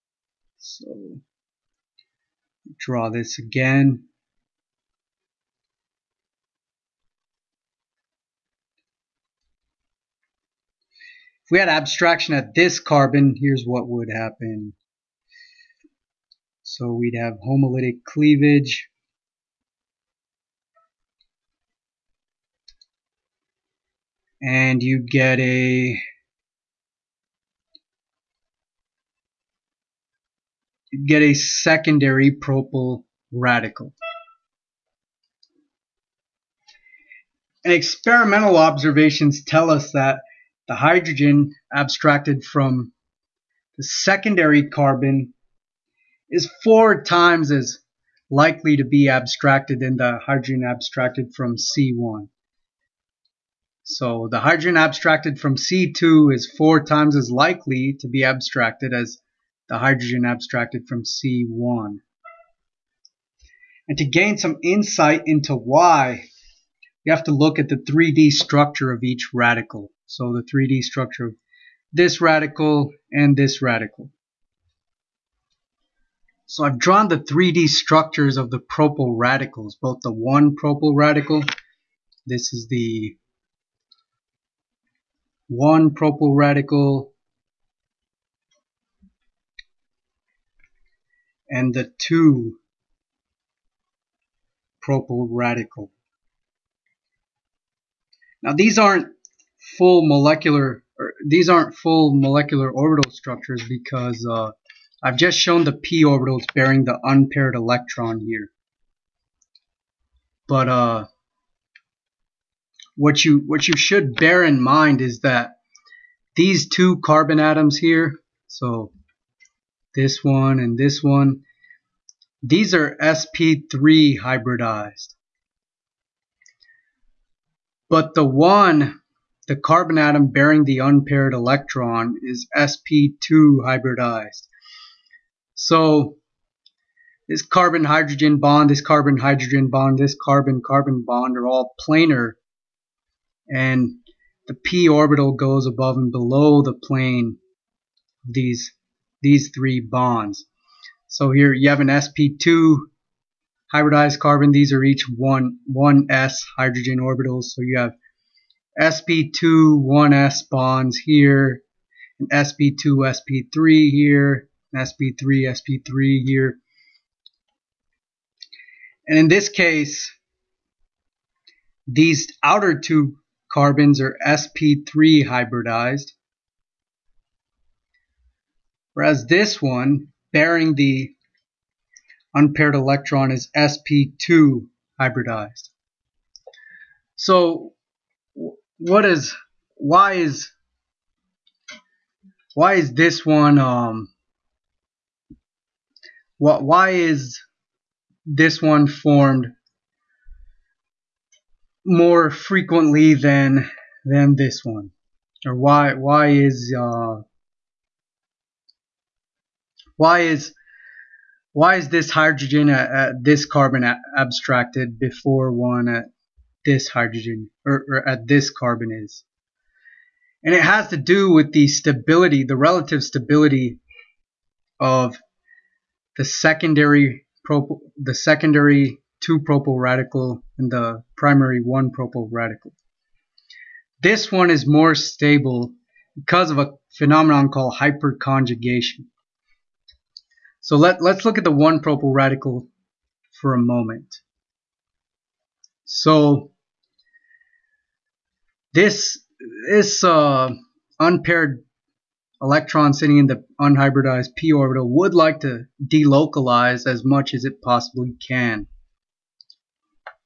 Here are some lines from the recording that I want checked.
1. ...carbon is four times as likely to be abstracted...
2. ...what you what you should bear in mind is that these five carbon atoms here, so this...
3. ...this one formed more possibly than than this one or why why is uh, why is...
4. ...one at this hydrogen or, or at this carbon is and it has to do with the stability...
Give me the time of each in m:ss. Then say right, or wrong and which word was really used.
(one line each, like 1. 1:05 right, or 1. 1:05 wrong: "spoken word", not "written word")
1. 0:44 right
2. 1:52 wrong: "two", not "five"
3. 3:18 wrong: "frequently", not "possibly"
4. 3:35 right.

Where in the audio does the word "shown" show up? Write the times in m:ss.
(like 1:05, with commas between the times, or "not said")
1:45.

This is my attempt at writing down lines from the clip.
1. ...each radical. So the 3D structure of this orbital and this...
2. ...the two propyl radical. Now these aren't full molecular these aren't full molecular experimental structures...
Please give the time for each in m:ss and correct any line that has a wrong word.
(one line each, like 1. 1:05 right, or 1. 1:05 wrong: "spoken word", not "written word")
1. 1:09 wrong: "radical", not "orbital"
2. 1:31 wrong: "orbital", not "experimental".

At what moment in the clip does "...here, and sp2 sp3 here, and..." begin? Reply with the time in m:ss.
2:40.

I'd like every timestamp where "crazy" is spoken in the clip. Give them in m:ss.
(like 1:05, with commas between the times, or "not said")
not said.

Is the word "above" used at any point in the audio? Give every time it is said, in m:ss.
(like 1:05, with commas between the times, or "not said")
2:25.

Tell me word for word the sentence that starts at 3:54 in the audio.
This one is more stable because of a phenomenon called hyperconjugation.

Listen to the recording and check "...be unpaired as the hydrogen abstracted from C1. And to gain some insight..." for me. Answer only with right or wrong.
wrong.